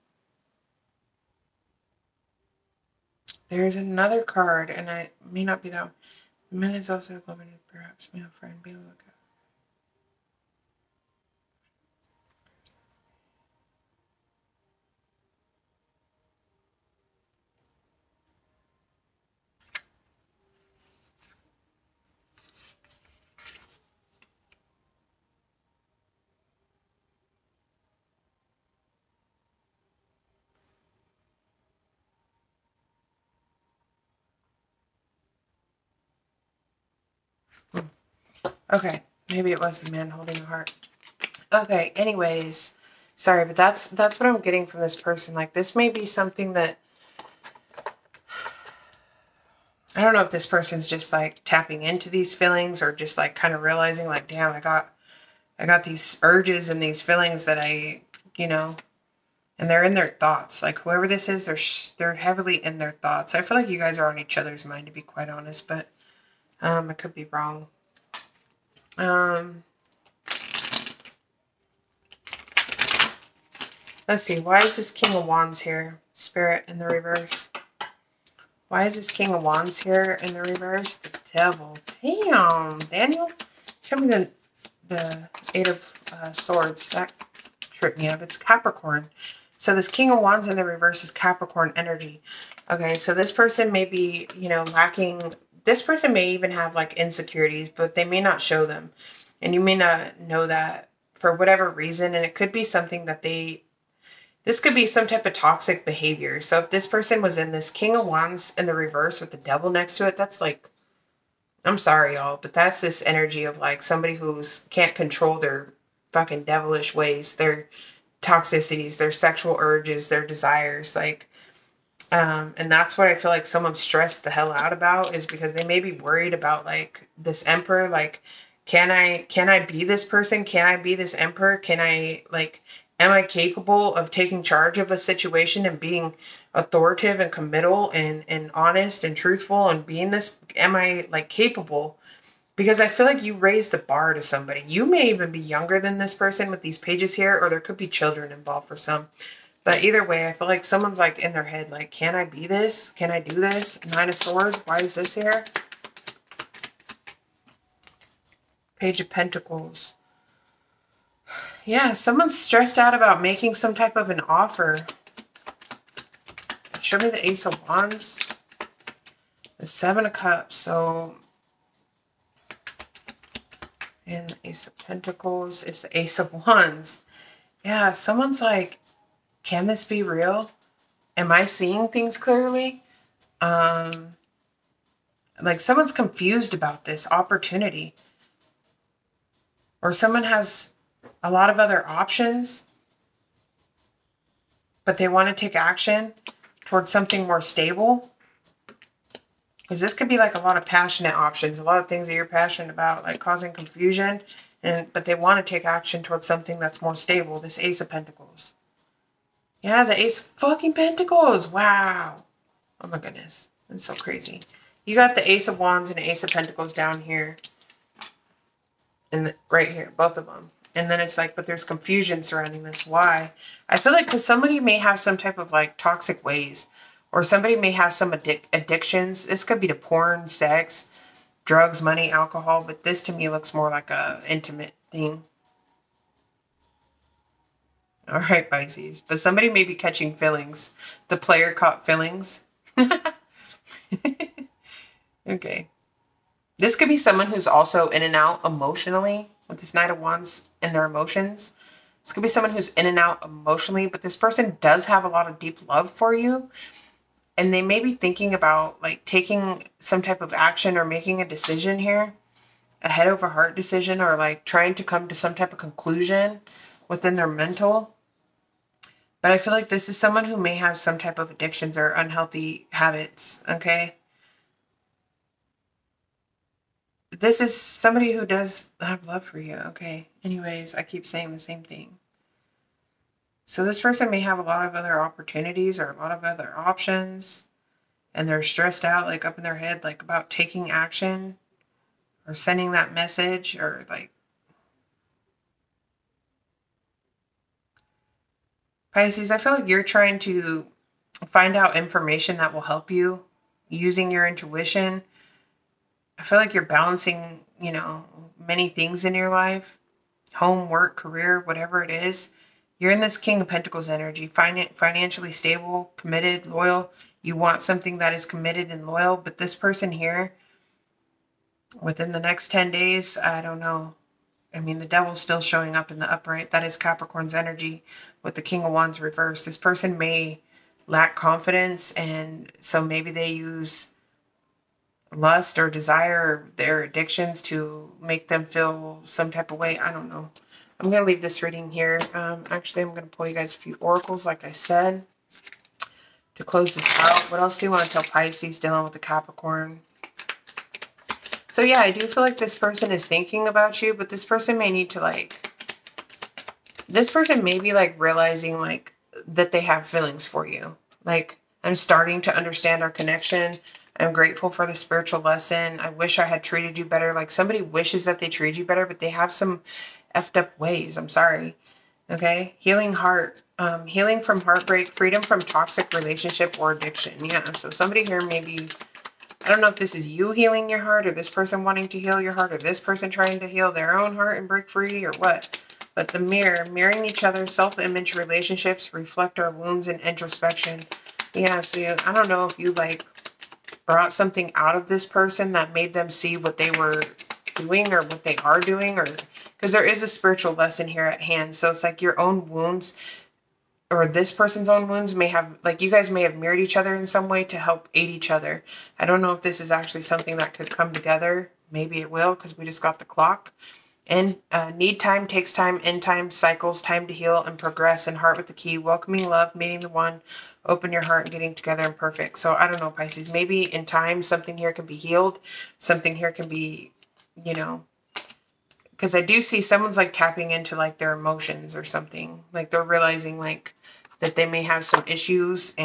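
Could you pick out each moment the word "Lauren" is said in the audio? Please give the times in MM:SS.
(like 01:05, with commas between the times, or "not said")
not said.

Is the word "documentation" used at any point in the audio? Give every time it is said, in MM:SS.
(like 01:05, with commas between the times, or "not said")
not said.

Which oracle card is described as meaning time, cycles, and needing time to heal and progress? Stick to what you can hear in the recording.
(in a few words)
the clock.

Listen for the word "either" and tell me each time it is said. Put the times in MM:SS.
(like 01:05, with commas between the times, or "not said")
02:29.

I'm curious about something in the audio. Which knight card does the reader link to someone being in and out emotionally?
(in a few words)
Knight of Wands.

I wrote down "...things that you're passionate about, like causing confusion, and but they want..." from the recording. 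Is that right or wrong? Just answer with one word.
right.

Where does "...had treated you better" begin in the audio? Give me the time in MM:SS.
06:06.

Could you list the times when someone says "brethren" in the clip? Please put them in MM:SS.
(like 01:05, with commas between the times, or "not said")
not said.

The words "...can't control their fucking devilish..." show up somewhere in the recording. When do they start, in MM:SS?
01:54.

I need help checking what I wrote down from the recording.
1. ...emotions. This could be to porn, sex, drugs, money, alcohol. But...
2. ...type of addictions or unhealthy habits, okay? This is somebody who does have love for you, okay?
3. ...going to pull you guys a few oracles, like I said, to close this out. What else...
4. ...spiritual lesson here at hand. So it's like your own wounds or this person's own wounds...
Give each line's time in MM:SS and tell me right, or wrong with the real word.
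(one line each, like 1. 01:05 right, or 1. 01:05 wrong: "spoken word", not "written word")
1. 03:48 wrong: "addictions", not "emotions"
2. 04:30 right
3. 05:42 right
4. 06:40 right.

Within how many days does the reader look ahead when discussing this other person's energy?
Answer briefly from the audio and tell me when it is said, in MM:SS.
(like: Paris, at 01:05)
10, at 05:22.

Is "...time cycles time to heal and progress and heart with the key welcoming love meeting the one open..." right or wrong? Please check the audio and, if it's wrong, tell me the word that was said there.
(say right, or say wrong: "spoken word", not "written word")
right.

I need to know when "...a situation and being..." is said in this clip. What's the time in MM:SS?
02:14.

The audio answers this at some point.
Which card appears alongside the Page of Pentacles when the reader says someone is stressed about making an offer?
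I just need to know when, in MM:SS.
02:33.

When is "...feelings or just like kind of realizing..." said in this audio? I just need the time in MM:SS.
00:52.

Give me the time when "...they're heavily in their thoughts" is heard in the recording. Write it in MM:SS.
01:01.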